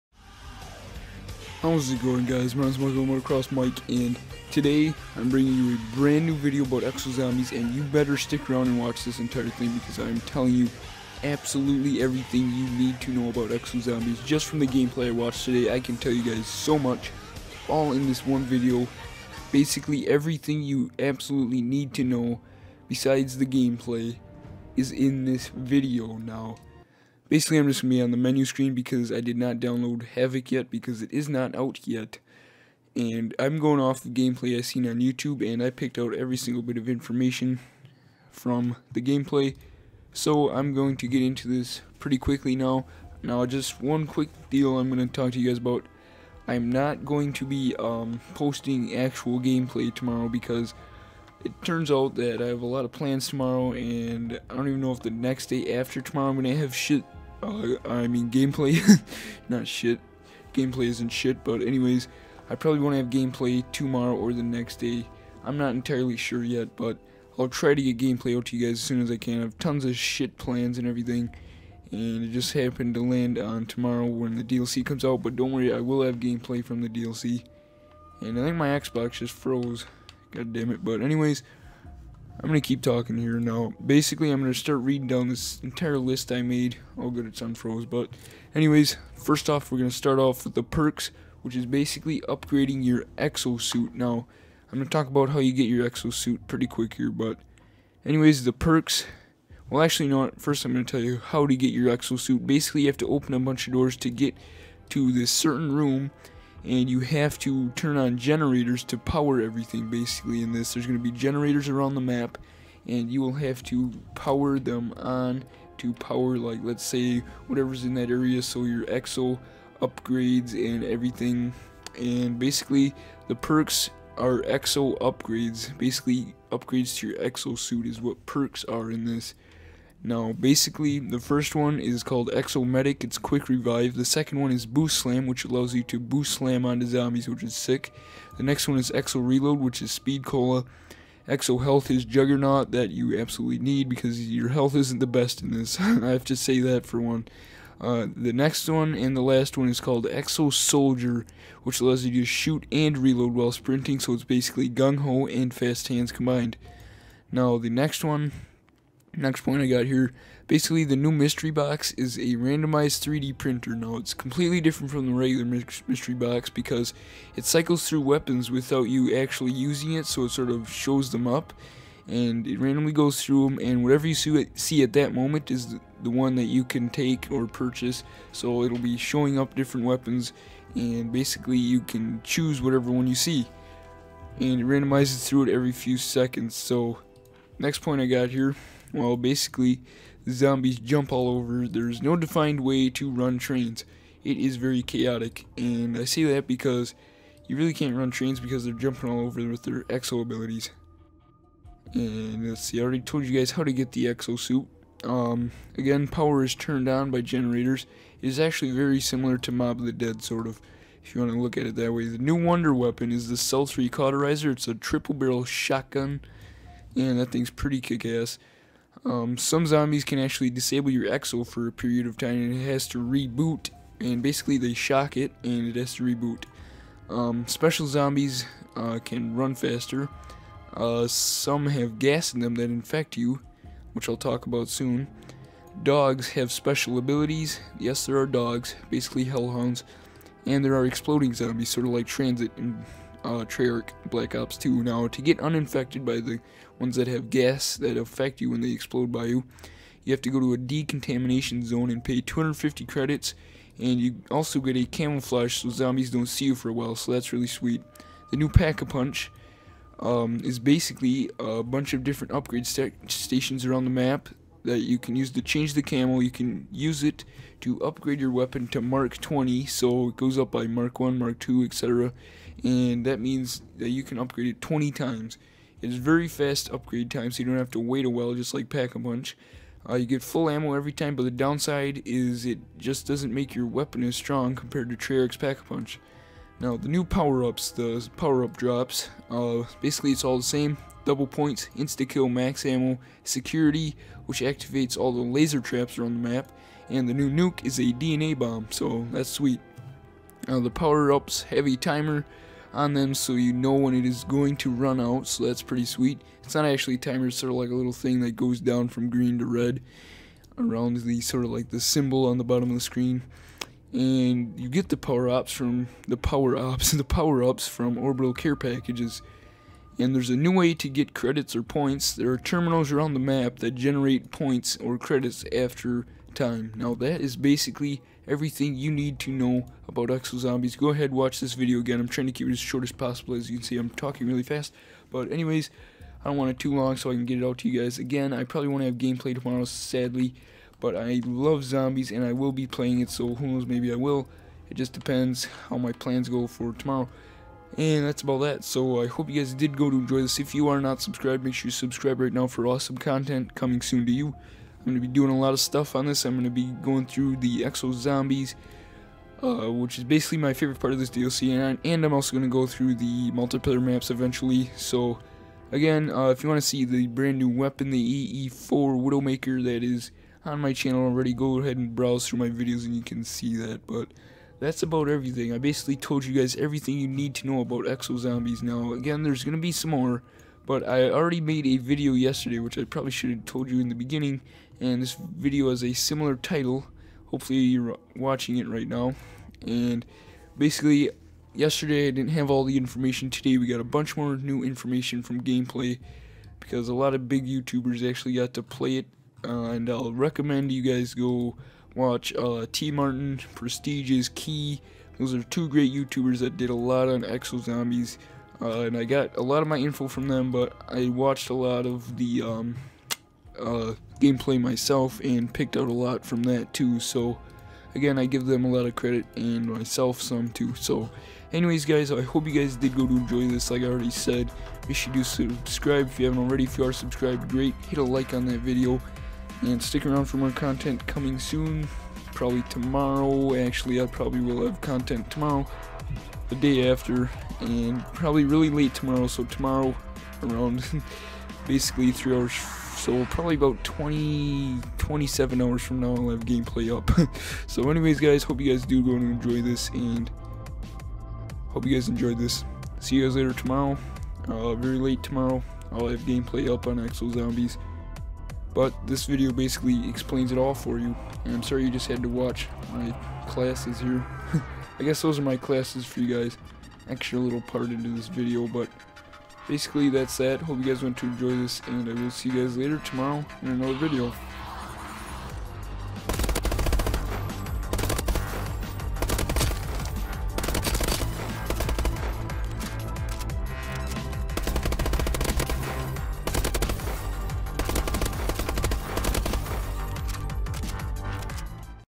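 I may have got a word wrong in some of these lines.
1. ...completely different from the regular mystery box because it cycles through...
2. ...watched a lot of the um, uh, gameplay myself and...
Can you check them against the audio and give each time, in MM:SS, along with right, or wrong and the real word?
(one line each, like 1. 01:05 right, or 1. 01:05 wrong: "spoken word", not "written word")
1. 02:44 right
2. 06:51 right.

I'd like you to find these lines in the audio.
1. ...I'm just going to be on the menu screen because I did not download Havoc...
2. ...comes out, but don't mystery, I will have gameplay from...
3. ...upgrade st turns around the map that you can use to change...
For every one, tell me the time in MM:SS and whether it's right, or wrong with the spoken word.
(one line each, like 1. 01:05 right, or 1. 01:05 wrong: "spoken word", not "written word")
1. 00:27 right
2. 01:14 wrong: "worry", not "mystery"
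3. 04:22 wrong: "stations", not "turns".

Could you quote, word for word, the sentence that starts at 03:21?
And let's see, I already told you guys how to get the exo suit.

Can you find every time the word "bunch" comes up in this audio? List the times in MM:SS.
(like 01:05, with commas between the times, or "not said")
01:43, 04:21, 06:33.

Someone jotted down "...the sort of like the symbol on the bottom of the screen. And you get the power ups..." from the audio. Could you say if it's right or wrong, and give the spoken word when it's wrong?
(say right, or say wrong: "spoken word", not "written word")
right.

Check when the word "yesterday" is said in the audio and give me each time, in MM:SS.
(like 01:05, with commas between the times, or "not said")
06:22, 06:31.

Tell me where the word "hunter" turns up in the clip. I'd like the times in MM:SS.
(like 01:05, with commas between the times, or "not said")
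not said.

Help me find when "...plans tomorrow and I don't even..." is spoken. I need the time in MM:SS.
00:52.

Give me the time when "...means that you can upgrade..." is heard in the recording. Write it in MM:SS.
04:33.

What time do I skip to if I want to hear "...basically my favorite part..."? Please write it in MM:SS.
06:00.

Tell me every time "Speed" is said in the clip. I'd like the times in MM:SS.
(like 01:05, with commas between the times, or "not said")
02:19.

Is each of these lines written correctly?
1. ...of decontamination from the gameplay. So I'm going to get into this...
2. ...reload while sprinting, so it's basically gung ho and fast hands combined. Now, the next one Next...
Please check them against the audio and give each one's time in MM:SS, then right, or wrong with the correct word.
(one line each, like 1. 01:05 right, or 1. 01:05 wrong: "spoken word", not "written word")
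1. 00:36 wrong: "information", not "decontamination"
2. 02:32 right.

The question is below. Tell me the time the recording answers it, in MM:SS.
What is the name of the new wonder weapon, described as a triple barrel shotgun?
03:33.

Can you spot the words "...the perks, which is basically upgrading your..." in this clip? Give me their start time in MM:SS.
01:30.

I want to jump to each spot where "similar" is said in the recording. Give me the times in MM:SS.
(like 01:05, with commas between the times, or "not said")
03:29, 06:25.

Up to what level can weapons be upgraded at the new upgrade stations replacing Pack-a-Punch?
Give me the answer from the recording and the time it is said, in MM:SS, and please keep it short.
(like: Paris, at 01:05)
Mark 20, at 04:28.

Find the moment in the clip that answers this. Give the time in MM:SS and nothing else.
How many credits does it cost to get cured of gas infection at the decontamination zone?
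04:12.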